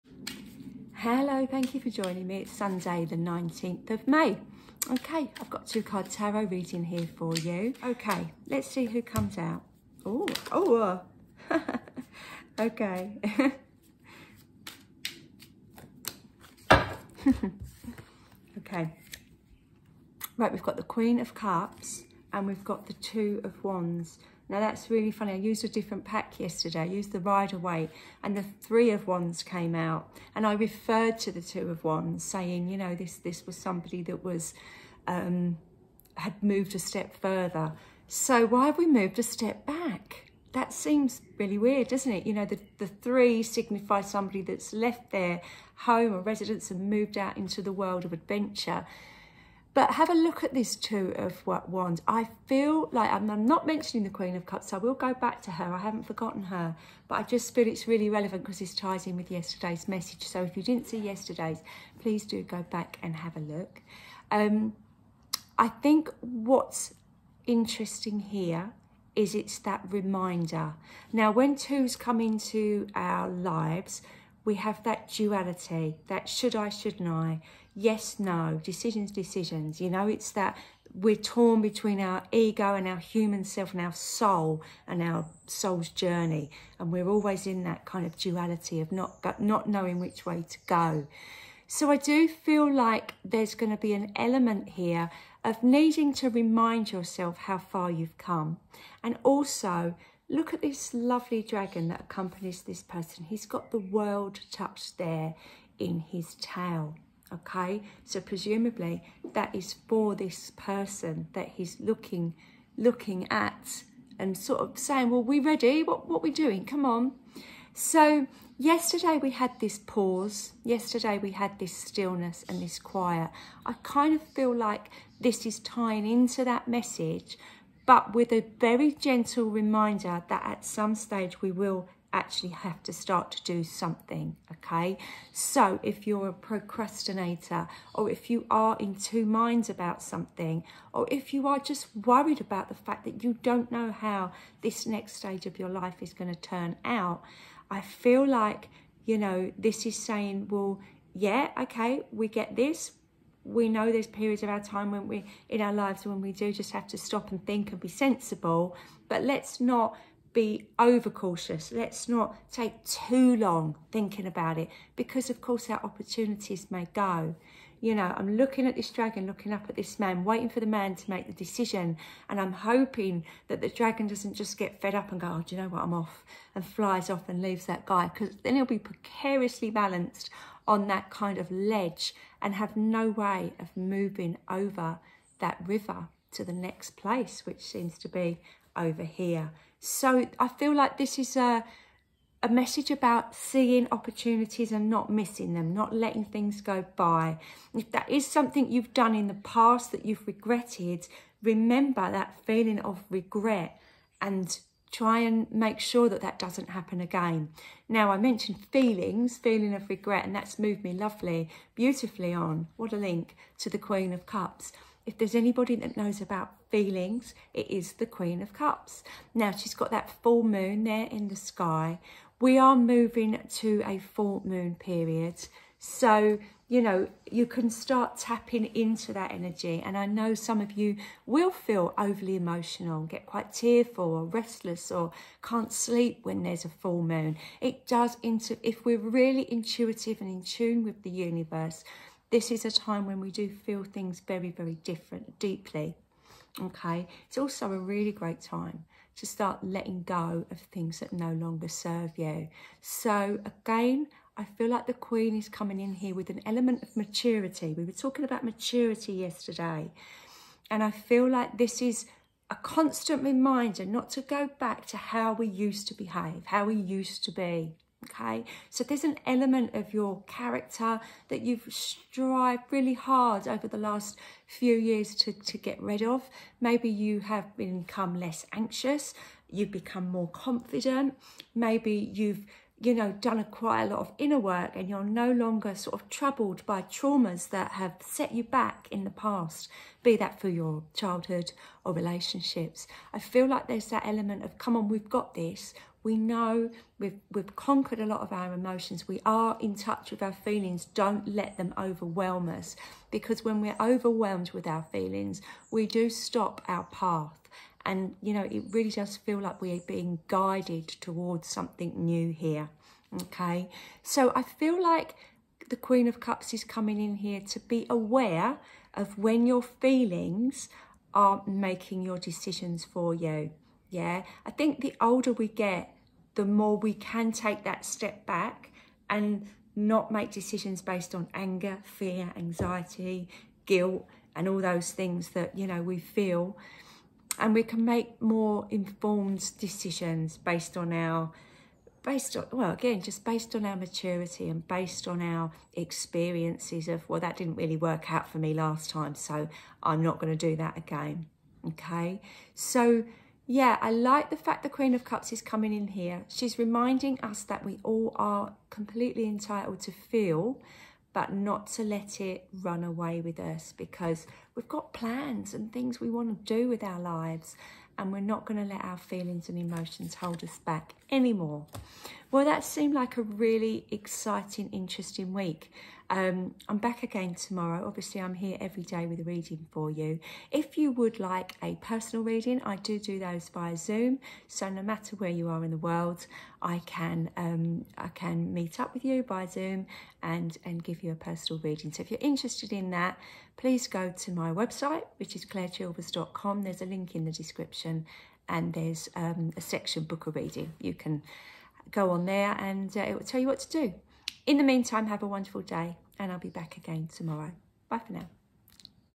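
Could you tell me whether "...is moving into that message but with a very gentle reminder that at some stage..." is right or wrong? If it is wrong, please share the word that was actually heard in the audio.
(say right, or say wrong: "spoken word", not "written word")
wrong: "tying", not "moving".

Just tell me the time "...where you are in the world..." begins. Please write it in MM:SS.
06:25.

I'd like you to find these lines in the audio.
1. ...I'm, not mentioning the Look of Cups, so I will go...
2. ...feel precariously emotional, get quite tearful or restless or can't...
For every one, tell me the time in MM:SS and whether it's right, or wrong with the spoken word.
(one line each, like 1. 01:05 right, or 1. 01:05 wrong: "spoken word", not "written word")
1. 00:53 wrong: "Queen", not "Look"
2. 03:51 wrong: "overly", not "precariously".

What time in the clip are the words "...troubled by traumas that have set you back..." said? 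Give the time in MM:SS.
04:46.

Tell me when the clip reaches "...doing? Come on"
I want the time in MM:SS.
01:56.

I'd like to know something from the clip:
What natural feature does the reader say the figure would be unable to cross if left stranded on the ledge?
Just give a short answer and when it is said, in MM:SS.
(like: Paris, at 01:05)
river, at 03:05.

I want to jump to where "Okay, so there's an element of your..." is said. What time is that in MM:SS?
04:28.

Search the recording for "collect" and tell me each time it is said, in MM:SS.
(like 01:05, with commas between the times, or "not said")
not said.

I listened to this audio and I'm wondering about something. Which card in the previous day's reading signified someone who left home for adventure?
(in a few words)
Three of Wands.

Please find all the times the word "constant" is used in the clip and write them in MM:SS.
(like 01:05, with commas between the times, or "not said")
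04:22.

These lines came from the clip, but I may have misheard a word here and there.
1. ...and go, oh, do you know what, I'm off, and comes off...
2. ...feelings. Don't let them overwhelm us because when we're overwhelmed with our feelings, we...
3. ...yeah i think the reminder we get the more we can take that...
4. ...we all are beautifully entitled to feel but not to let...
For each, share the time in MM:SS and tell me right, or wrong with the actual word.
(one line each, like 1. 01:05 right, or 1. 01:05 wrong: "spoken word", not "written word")
1. 02:55 wrong: "flies", not "comes"
2. 05:00 right
3. 05:23 wrong: "older", not "reminder"
4. 05:57 wrong: "completely", not "beautifully".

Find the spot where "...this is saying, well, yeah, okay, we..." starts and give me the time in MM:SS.
02:29.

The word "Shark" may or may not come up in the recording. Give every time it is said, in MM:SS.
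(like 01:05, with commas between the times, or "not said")
not said.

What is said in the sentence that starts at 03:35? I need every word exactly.
If there's anybody that knows about feelings, it is the Queen of Cups.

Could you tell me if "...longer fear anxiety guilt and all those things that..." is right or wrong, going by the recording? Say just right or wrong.
wrong.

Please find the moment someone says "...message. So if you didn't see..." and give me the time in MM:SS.
00:59.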